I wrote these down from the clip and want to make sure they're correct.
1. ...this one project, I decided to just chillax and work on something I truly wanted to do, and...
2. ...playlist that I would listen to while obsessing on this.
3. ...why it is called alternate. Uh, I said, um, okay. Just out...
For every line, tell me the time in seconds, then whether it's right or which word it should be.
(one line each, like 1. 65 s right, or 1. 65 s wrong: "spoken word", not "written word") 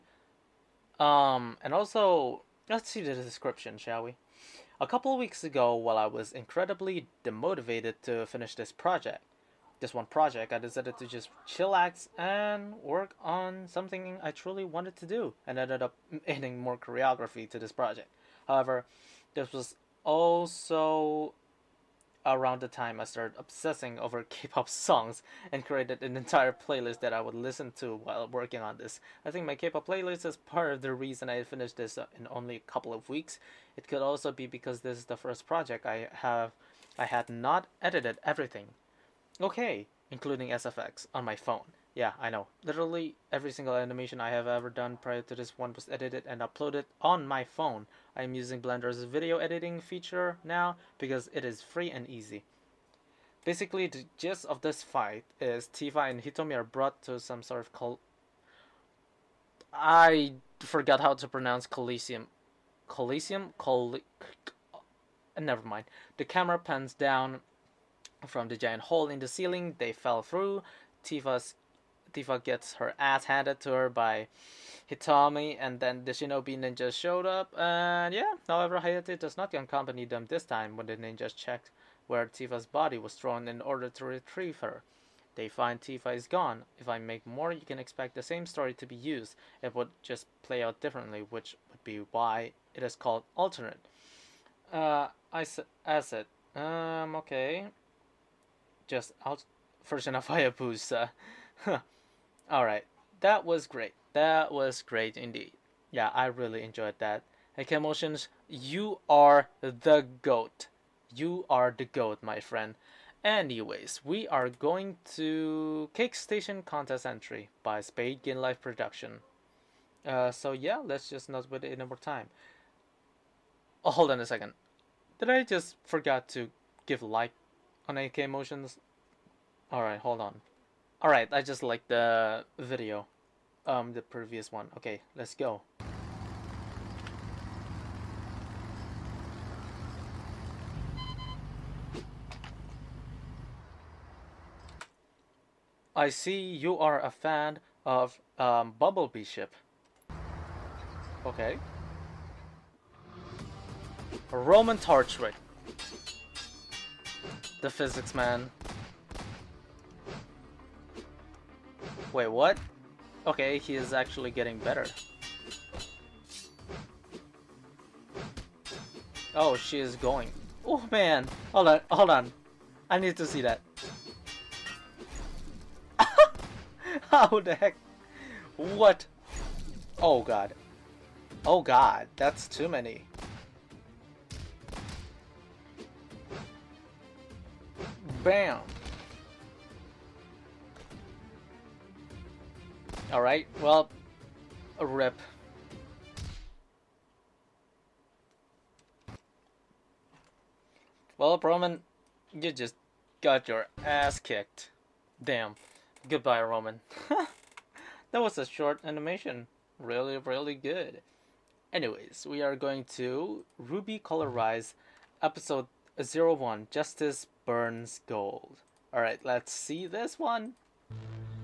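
1. 9 s right
2. 26 s wrong: "working", not "obsessing"
3. 92 s right.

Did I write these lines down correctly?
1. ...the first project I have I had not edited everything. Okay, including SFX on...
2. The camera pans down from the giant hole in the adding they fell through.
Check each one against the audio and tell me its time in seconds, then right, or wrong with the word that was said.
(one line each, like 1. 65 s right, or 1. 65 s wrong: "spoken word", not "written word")
1. 35 s right
2. 66 s wrong: "ceiling", not "adding".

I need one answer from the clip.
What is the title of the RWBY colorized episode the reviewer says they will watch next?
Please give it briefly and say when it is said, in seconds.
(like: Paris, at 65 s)
Justice Burns Gold, at 216 s.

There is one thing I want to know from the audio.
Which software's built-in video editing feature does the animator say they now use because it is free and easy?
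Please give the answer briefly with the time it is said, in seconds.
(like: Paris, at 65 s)
Blender, at 48 s.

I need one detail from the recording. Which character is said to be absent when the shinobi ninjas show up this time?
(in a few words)
Hayate.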